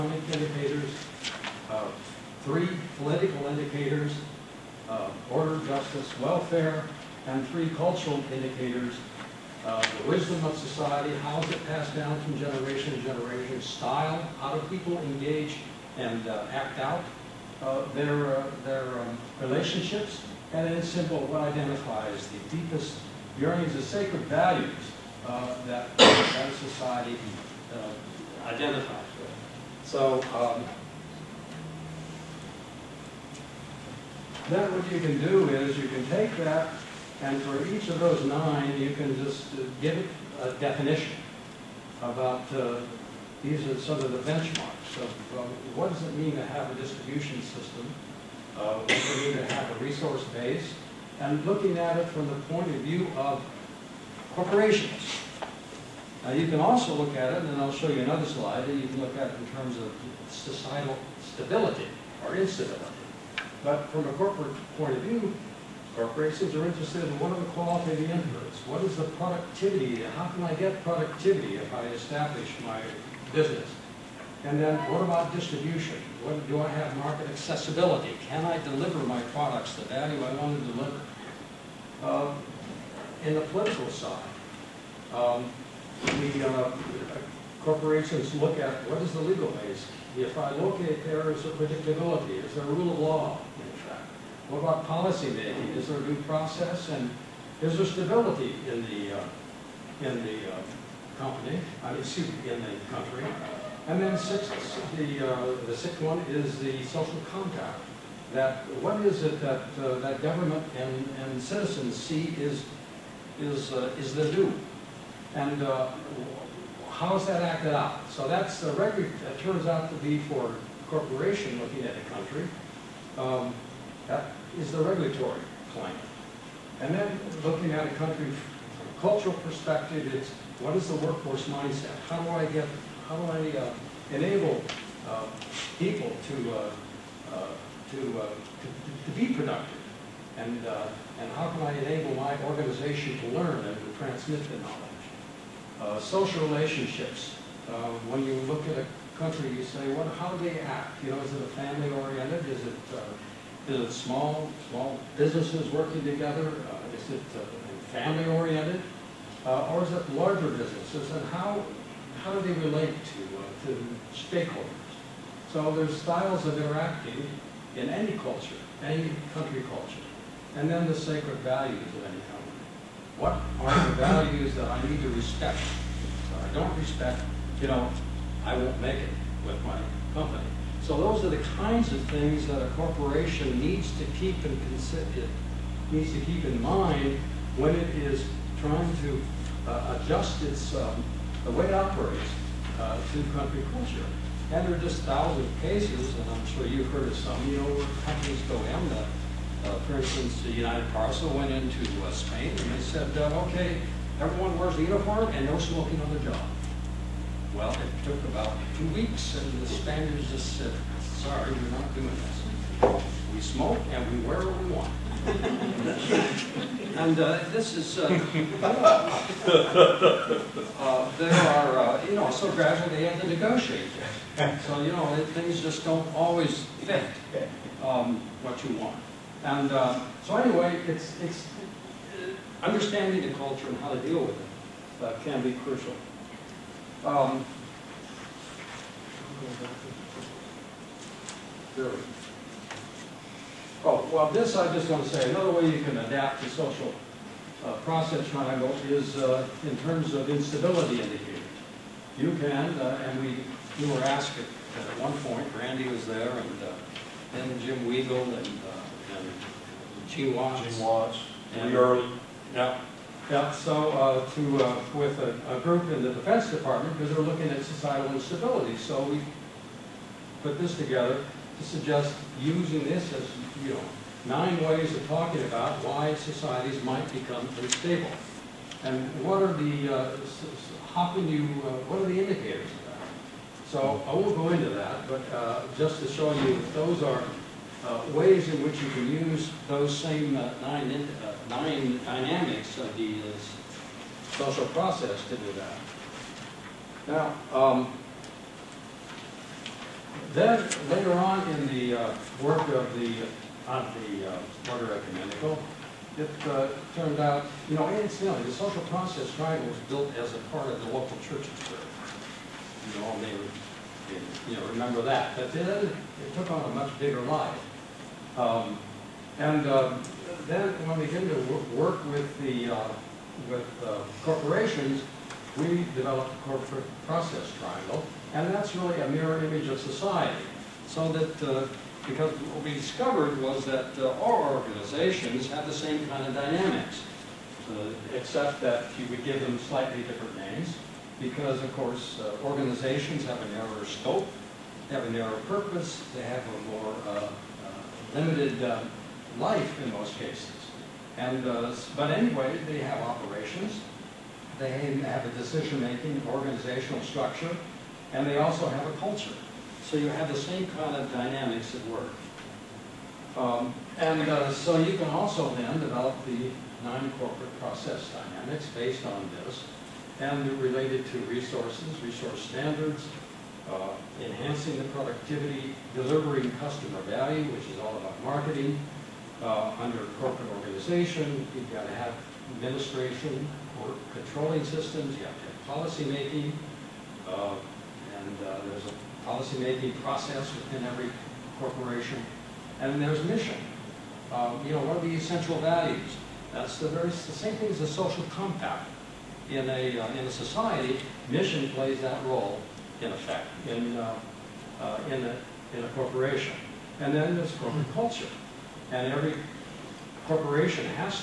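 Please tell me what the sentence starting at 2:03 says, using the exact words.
Um, that is the regulatory climate, And then looking at a country from a cultural perspective, it's what is the workforce mindset?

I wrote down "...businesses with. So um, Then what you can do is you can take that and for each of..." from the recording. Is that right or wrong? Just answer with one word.
wrong.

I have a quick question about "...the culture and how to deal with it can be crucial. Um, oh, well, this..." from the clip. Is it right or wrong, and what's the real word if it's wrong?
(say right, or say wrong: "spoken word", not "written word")
right.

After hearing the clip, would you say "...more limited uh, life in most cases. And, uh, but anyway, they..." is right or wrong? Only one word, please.
right.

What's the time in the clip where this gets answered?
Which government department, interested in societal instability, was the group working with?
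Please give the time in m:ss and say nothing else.
4:26.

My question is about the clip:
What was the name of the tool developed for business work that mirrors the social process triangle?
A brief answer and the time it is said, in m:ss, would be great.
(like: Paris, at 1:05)
corporate process triangle, at 5:26.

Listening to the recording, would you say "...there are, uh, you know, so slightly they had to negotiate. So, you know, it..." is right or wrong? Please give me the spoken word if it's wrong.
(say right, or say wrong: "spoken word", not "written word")
wrong: "gradually", not "slightly".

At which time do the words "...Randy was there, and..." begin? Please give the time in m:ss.
4:15.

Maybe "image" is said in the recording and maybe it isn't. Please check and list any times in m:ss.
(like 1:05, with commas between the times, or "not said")
5:29.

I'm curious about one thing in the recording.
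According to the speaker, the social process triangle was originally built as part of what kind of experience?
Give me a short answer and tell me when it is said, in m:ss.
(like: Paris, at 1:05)
local church, at 5:10.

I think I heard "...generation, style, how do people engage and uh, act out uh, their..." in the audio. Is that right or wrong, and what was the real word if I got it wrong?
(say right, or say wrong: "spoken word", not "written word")
right.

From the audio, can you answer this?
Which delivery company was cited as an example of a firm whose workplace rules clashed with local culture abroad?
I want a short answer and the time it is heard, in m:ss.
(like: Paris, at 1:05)
United Parcel, at 3:20.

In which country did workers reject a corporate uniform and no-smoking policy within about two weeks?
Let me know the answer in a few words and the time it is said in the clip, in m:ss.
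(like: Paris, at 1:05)
Spain, at 3:22.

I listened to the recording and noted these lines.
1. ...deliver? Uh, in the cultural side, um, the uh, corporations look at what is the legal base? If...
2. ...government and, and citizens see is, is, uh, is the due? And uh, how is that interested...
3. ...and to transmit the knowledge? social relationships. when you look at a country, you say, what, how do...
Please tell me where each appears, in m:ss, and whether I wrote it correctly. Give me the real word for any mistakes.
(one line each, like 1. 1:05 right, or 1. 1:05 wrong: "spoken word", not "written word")
1. 1:20 wrong: "political", not "cultural"
2. 1:50 wrong: "acted", not "interested"
3. 2:23 right.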